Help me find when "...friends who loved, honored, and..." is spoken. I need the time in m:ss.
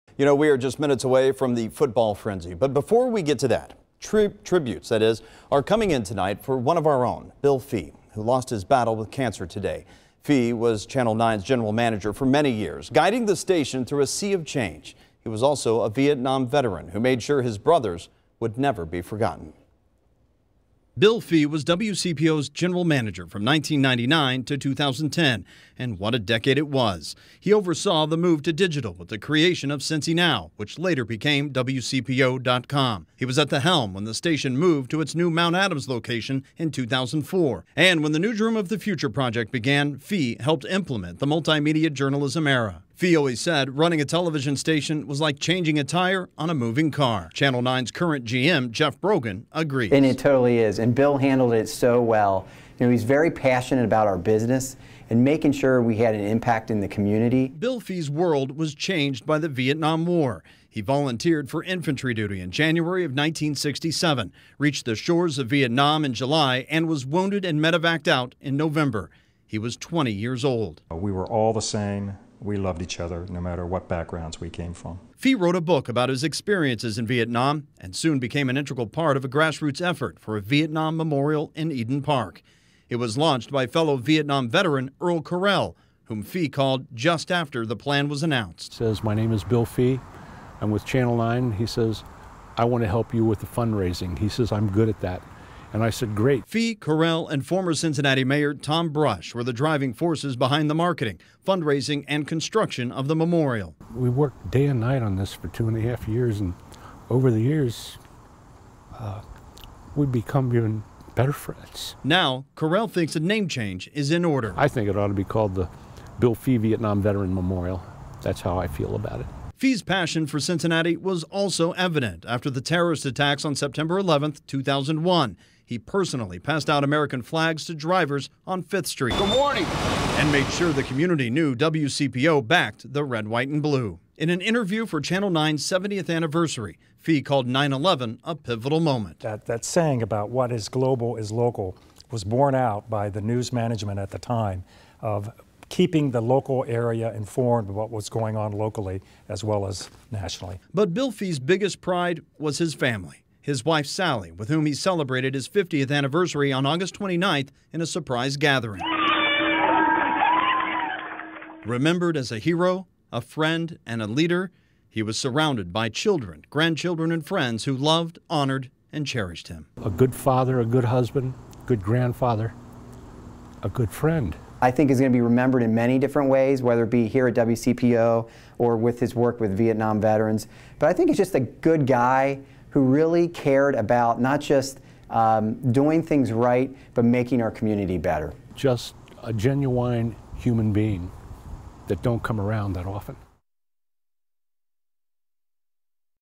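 2:47.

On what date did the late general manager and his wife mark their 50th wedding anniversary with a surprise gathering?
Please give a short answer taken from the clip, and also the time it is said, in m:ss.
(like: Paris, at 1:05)
August 29, at 2:36.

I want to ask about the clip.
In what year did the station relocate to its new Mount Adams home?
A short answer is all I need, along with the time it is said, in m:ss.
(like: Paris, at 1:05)
2004, at 0:36.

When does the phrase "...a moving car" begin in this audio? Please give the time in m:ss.
0:46.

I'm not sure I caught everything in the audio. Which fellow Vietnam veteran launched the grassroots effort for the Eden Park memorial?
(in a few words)
Earl Correll.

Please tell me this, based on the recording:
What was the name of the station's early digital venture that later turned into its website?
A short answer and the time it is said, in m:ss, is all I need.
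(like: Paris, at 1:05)
Cincy Now, at 0:29.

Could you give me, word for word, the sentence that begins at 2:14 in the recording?
In an interview for Channel 9's 70th anniversary, Fee called 9 11 a pivotal moment.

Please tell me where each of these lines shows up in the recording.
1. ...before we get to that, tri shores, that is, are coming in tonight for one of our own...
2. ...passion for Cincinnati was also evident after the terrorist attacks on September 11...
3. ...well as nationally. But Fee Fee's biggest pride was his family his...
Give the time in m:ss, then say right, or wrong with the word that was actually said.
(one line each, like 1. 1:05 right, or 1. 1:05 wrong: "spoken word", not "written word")
1. 0:02 wrong: "tributes", not "shores"
2. 1:59 right
3. 2:29 wrong: "Bill", not "Fee".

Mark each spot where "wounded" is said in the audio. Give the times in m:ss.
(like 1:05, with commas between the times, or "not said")
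1:07.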